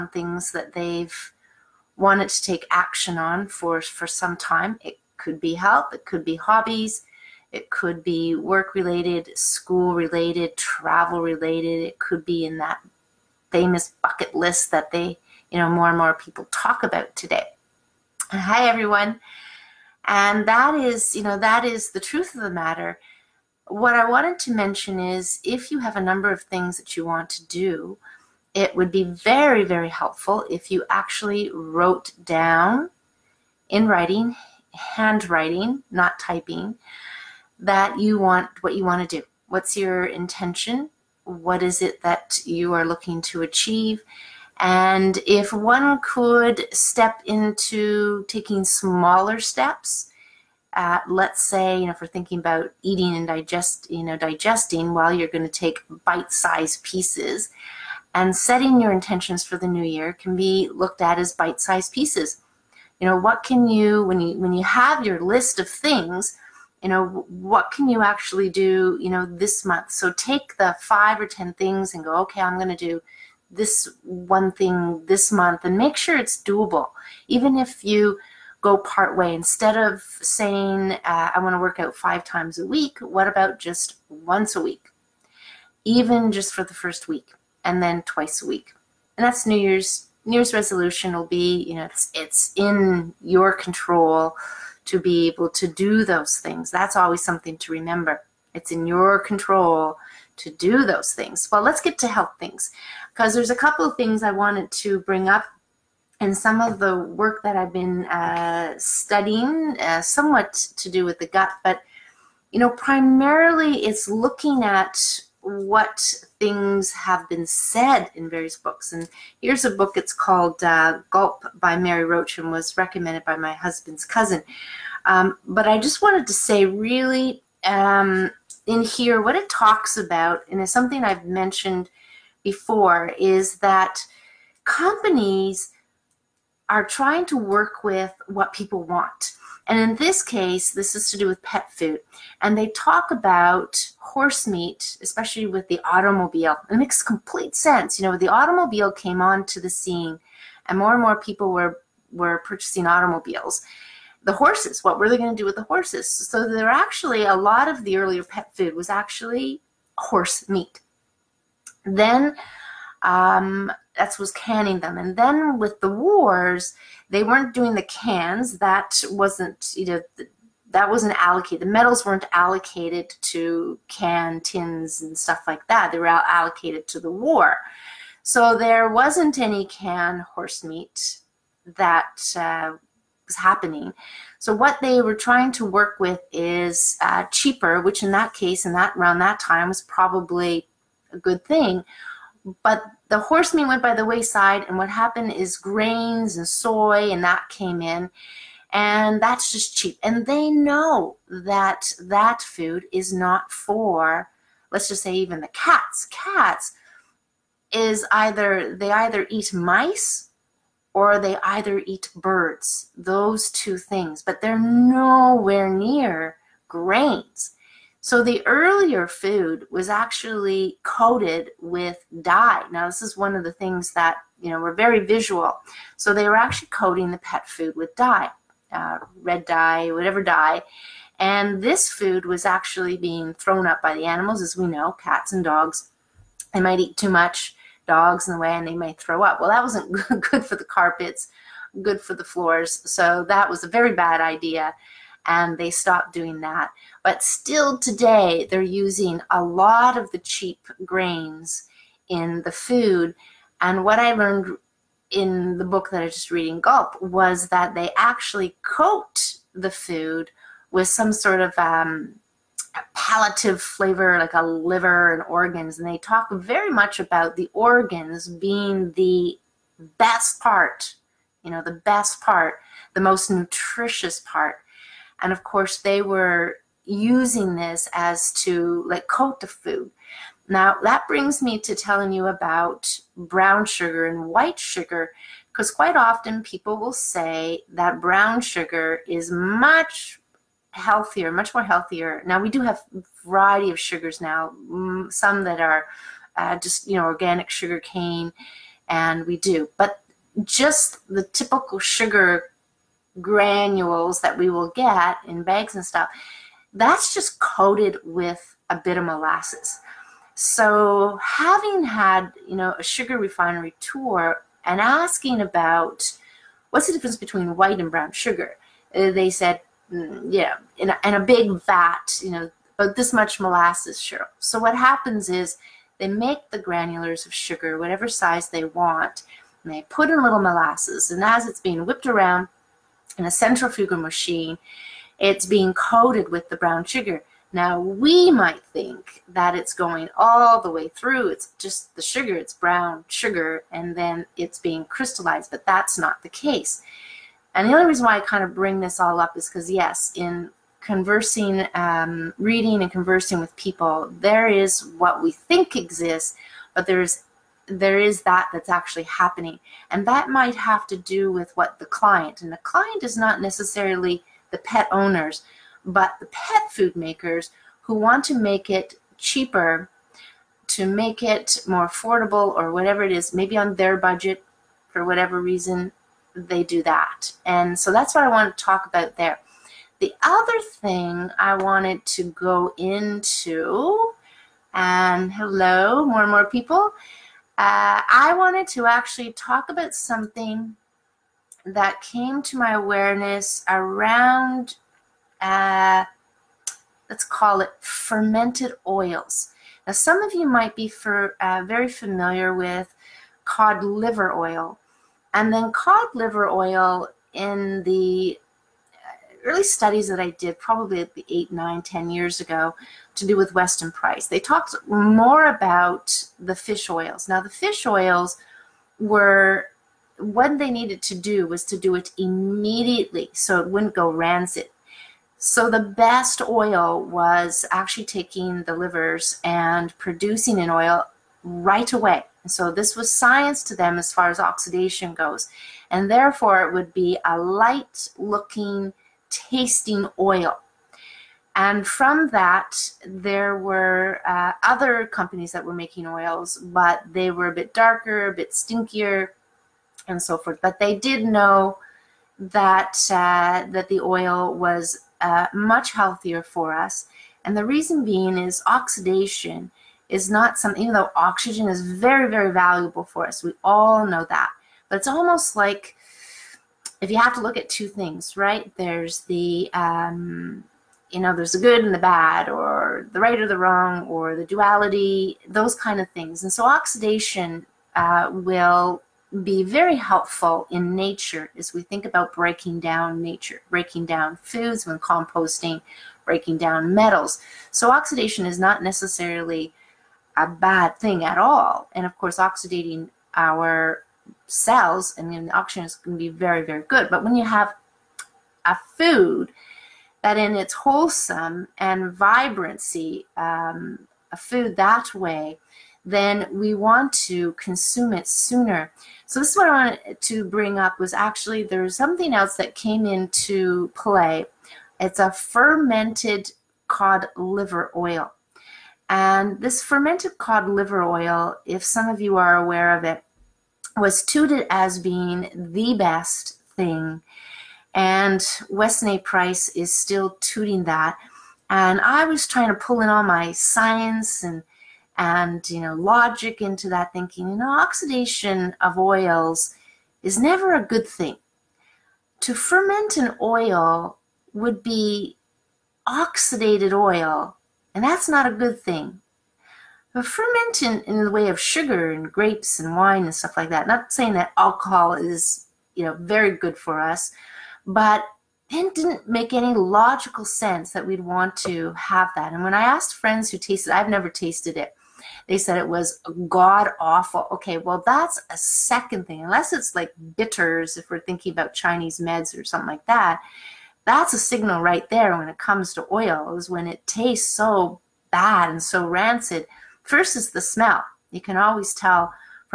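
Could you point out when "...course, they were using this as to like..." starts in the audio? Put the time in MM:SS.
04:35.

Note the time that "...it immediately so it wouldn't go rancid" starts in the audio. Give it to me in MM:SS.
07:01.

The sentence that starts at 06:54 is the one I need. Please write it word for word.
They talked more about the fish oils.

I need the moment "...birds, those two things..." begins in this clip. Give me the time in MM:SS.
03:32.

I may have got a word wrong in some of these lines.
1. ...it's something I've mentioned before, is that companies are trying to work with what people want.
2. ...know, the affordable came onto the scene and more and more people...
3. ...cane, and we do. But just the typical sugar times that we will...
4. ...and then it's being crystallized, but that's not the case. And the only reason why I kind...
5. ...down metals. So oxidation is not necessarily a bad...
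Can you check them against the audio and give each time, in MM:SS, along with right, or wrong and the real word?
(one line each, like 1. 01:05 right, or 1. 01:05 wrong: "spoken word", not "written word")
1. 02:10 right
2. 02:28 wrong: "automobile", not "affordable"
3. 04:57 wrong: "granules", not "times"
4. 05:43 right
5. 08:06 right.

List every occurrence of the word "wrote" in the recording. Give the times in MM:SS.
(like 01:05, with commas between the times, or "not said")
00:31.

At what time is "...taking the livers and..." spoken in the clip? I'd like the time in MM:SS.
07:08.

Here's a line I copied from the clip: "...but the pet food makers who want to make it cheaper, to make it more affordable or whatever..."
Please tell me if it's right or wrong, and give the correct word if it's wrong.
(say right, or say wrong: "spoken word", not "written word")
right.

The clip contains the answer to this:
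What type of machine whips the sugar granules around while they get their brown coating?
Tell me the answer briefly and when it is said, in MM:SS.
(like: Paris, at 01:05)
Centrifugal machine, at 05:33.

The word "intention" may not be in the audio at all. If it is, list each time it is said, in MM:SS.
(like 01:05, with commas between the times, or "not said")
00:40, 00:58.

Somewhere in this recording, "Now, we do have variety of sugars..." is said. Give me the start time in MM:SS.
04:52.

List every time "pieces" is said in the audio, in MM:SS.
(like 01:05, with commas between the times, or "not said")
00:56, 01:01.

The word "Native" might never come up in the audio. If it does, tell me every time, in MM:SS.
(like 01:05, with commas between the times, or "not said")
not said.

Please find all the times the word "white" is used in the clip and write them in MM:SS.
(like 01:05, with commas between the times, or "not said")
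04:44, 05:17.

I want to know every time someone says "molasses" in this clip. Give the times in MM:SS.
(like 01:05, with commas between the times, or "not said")
05:09, 05:23, 05:30.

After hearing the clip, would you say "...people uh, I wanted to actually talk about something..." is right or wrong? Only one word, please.
right.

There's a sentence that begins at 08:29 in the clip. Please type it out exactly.
So this is what I wanted to bring up was actually there's something else that came into play.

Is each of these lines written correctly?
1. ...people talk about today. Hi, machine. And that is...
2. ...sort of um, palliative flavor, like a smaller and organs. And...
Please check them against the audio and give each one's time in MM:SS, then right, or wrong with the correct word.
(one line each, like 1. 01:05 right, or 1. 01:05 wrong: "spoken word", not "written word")
1. 00:16 wrong: "everyone", not "machine"
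2. 04:21 wrong: "liver", not "smaller".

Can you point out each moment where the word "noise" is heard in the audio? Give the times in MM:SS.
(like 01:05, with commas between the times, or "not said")
not said.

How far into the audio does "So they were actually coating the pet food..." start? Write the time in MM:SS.
03:45.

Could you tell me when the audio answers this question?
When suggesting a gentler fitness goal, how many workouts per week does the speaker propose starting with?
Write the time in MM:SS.
01:24.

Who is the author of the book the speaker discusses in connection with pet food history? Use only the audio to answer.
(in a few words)
Mary Roach.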